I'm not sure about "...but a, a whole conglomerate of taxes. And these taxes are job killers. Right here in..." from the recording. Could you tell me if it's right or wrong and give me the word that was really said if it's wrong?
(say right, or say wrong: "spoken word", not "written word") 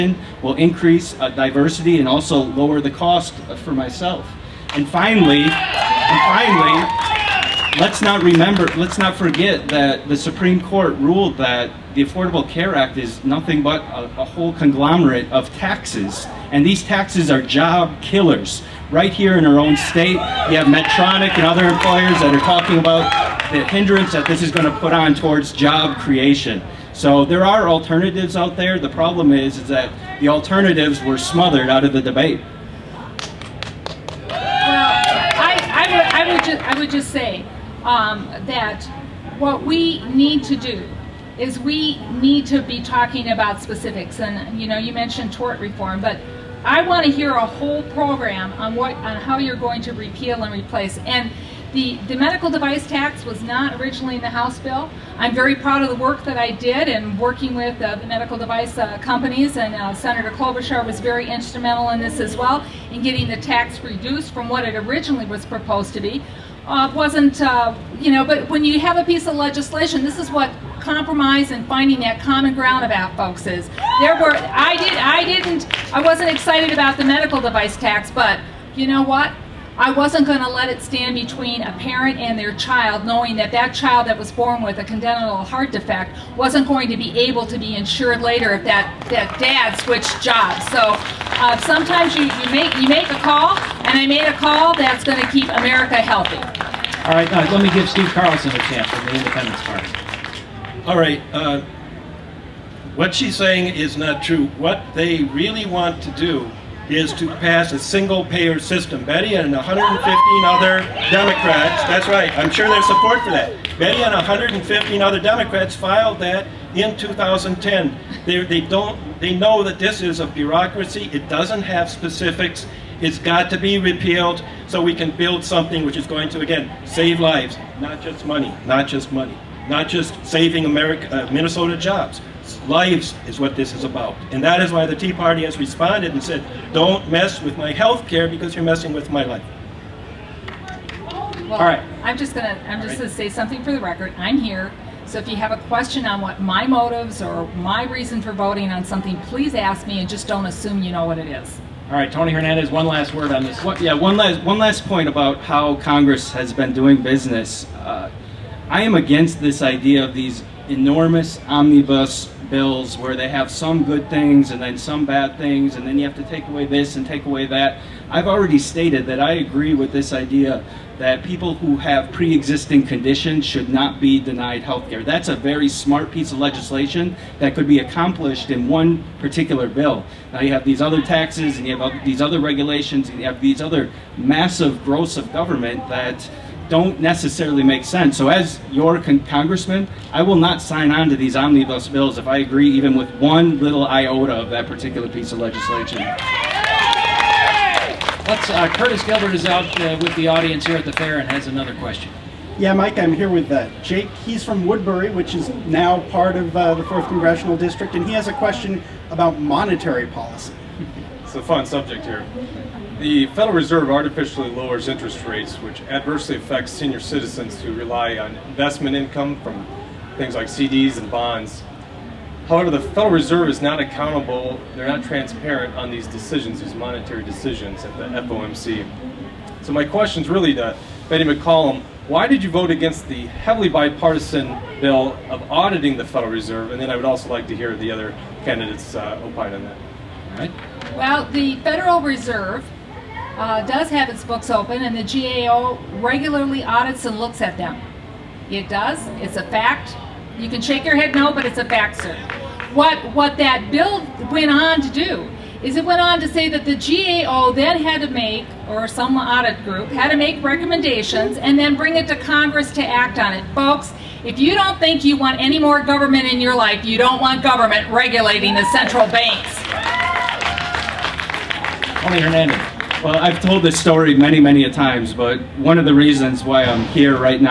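right.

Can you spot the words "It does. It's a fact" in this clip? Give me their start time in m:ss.
4:08.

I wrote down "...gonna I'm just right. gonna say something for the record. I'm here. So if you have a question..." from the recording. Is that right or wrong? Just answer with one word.
right.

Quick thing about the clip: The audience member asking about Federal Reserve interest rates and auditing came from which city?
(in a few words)
Woodbury.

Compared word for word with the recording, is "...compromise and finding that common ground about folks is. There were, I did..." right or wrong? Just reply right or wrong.
right.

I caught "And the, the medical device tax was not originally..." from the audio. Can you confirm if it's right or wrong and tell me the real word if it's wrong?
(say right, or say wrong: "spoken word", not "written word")
right.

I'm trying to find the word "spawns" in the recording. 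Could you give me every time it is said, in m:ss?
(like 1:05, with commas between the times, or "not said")
not said.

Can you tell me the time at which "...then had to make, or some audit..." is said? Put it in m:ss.
4:17.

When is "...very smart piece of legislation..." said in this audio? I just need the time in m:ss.
2:55.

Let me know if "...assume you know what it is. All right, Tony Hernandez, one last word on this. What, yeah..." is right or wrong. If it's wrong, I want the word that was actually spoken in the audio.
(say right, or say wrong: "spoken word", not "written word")
right.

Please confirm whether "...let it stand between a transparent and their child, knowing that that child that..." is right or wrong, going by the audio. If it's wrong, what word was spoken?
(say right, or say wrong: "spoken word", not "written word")
wrong: "parent", not "transparent".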